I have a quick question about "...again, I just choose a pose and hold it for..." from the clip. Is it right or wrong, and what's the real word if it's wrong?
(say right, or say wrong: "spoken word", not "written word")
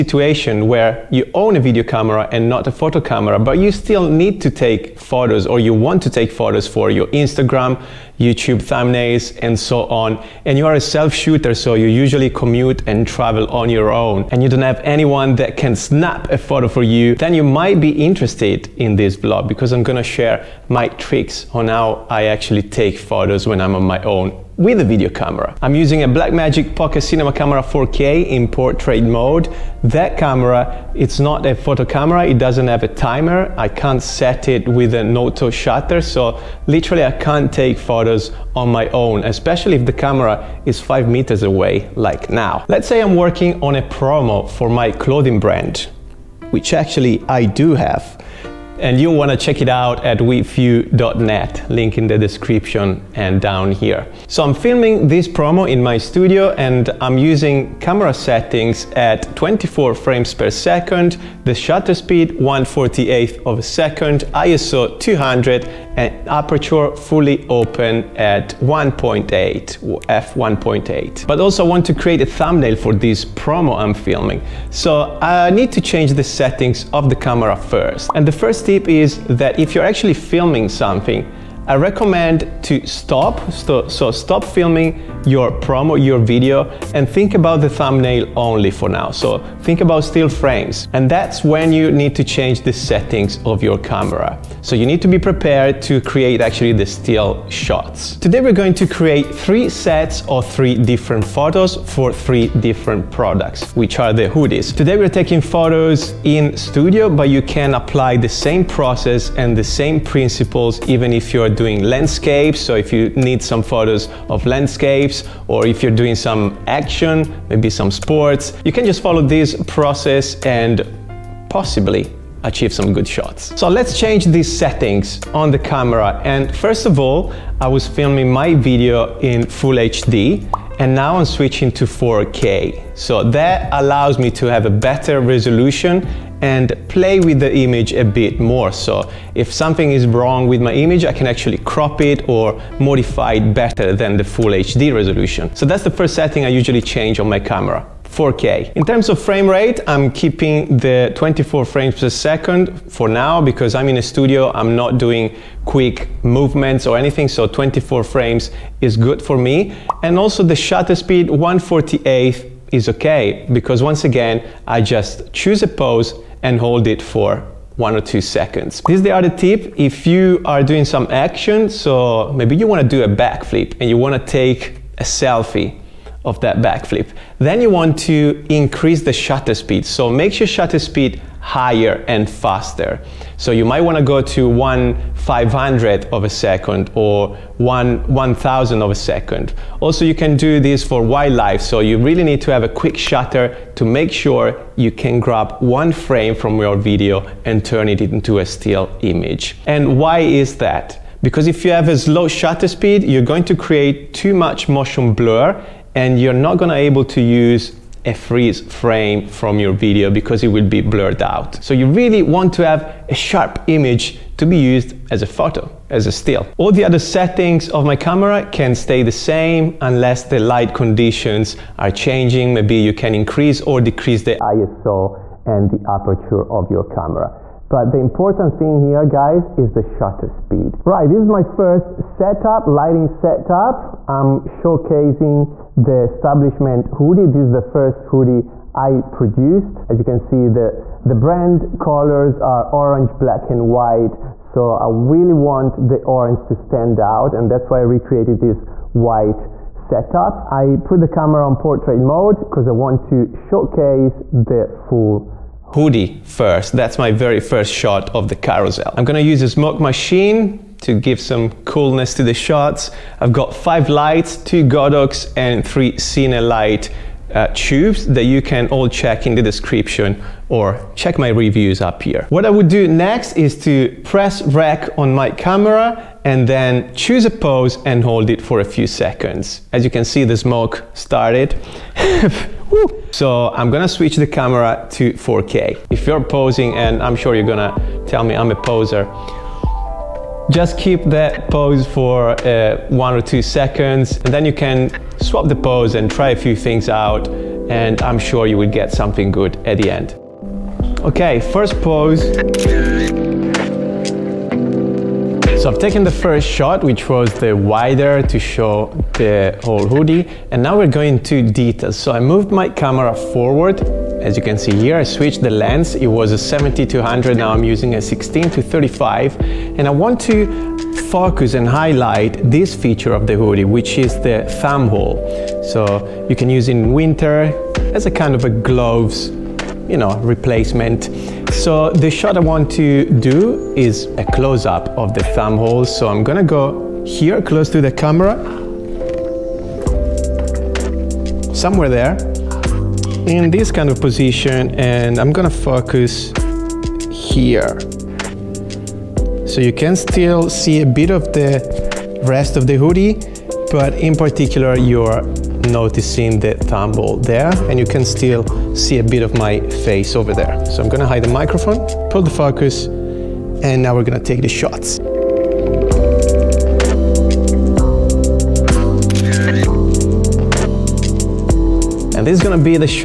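right.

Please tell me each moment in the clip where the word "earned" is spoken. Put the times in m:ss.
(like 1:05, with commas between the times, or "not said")
not said.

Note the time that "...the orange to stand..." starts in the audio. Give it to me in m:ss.
4:05.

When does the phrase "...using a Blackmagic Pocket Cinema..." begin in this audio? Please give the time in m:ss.
0:25.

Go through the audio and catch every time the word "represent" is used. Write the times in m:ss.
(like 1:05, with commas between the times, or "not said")
not said.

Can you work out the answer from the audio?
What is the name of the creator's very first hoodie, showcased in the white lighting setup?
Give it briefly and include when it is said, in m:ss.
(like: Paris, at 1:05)
Establishment hoodie, at 3:56.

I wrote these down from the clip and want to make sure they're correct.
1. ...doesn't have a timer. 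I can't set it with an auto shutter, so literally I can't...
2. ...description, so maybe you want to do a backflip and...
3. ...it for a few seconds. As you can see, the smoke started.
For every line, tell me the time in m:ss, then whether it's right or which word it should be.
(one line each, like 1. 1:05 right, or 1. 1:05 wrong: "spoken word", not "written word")
1. 0:32 right
2. 2:51 wrong: "action", not "description"
3. 4:38 right.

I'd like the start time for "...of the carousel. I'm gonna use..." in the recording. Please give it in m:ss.
4:18.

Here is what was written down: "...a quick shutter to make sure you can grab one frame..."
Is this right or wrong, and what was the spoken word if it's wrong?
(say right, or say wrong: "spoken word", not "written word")
right.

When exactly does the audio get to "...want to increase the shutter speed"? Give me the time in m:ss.
2:57.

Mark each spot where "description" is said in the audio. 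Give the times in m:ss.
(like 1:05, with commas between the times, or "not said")
0:52, 4:29.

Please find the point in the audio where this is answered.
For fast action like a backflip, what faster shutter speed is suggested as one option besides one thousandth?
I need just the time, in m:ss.
3:04.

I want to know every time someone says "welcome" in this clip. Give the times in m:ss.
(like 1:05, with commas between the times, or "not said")
not said.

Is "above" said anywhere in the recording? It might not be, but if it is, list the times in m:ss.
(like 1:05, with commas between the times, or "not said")
not said.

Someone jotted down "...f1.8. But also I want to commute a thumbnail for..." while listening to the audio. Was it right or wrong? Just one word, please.
wrong.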